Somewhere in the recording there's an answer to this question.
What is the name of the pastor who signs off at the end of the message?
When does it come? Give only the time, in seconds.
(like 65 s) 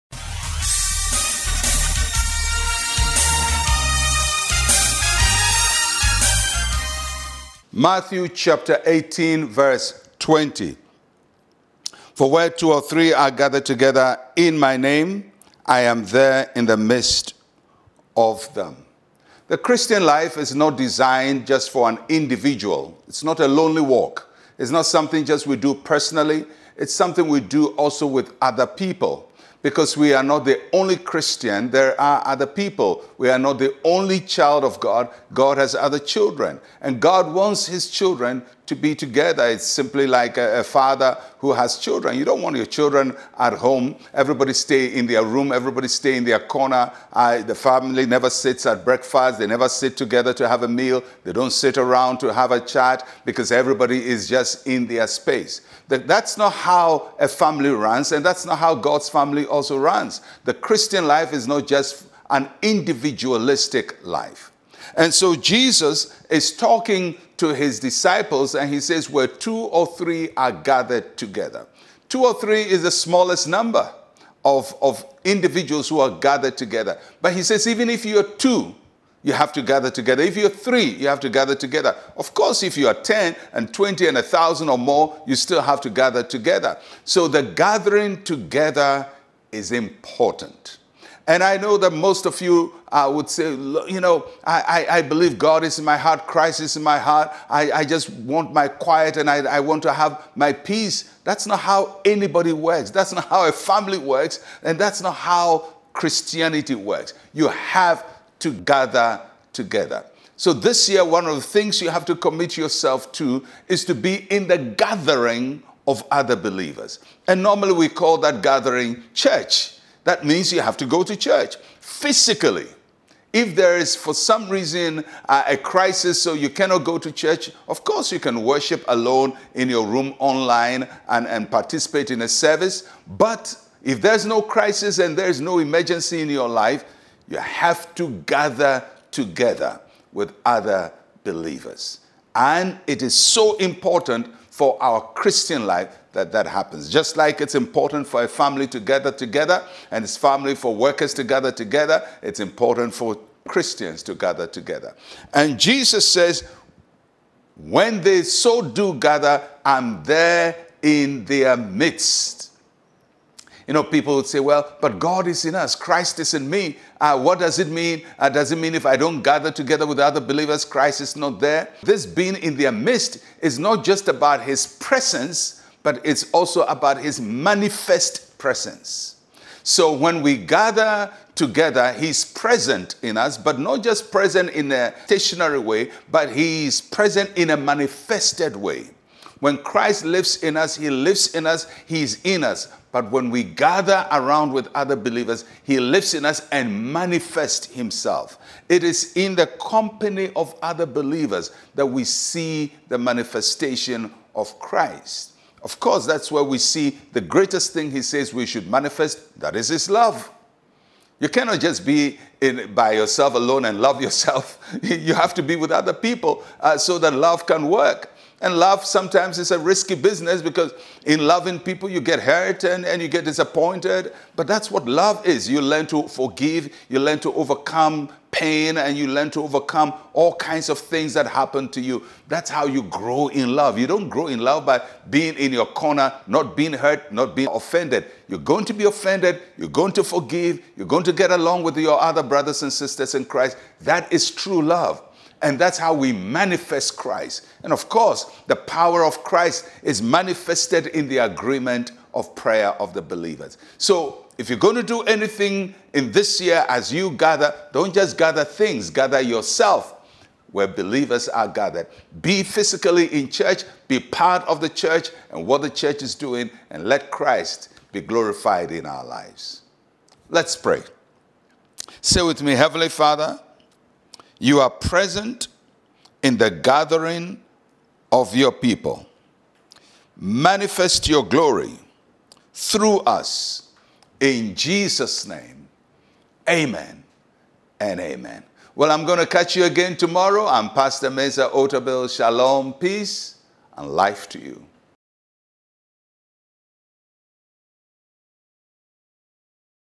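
291 s.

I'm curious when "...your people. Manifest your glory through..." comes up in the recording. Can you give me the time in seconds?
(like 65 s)
278 s.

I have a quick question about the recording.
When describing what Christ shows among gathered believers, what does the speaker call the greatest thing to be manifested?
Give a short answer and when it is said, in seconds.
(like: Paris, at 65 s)
His love, at 209 s.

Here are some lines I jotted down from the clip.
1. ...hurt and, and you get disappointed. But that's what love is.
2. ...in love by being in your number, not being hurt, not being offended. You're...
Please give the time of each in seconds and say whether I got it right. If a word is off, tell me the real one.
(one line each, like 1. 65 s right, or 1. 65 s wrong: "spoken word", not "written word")
1. 222 s right
2. 234 s wrong: "corner", not "number".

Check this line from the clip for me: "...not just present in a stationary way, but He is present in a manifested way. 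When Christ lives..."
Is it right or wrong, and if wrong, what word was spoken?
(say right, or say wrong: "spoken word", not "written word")
right.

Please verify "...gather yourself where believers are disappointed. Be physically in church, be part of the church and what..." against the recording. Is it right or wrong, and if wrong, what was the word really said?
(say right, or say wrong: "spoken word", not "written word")
wrong: "gathered", not "disappointed".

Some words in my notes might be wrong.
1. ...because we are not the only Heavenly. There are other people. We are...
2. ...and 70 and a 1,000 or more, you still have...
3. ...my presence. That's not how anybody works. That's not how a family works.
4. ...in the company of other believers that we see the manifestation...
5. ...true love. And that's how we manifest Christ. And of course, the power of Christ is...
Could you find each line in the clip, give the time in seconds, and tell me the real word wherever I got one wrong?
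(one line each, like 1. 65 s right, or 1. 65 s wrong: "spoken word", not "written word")
1. 29 s wrong: "Christian", not "Heavenly"
2. 83 s wrong: "20", not "70"
3. 100 s wrong: "peace", not "presence"
4. 199 s right
5. 244 s right.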